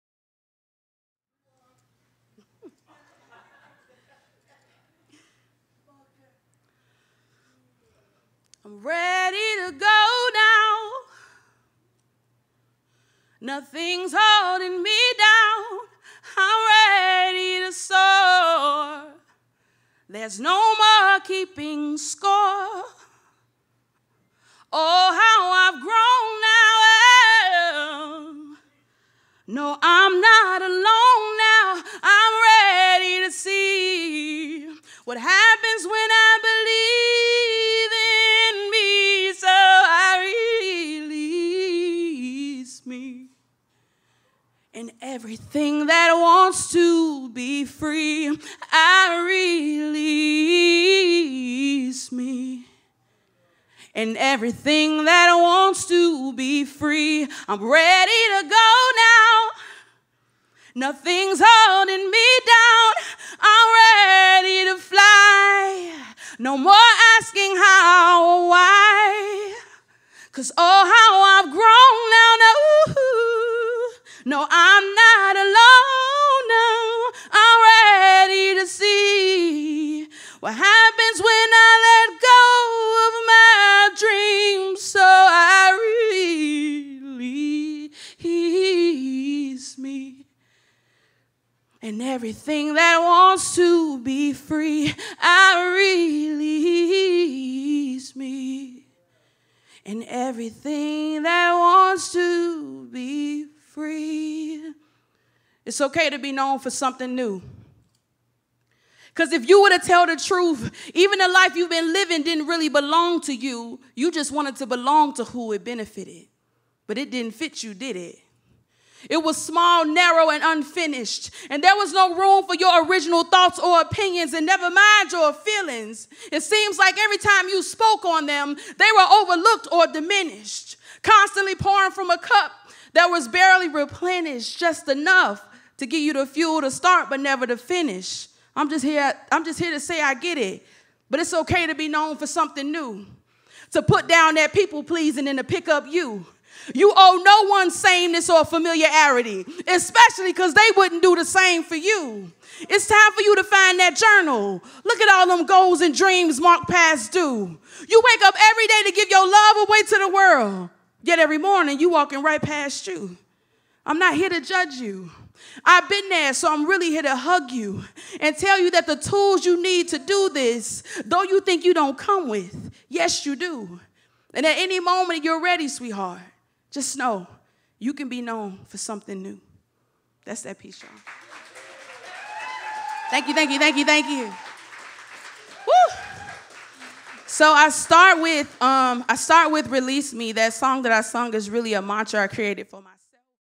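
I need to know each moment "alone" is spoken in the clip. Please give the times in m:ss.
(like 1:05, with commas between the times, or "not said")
0:30, 1:15.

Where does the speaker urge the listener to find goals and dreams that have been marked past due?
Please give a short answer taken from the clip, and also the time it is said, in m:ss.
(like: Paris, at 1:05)
journal, at 2:33.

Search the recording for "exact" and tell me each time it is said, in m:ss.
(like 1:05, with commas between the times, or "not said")
not said.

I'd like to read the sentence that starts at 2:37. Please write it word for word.
You wake up every day to give your love away to the world.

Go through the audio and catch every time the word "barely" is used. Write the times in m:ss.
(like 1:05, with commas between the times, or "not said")
2:13.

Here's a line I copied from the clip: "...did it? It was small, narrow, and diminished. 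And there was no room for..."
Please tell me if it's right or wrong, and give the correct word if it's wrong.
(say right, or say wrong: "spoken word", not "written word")
wrong: "unfinished", not "diminished".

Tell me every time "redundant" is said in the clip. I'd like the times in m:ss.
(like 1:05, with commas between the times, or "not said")
not said.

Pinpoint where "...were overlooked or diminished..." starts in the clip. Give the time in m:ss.
2:08.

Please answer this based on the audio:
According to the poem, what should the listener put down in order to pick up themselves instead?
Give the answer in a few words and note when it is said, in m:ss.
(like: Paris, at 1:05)
people pleasing, at 2:24.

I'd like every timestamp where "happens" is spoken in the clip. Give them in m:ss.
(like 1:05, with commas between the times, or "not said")
0:35, 1:20.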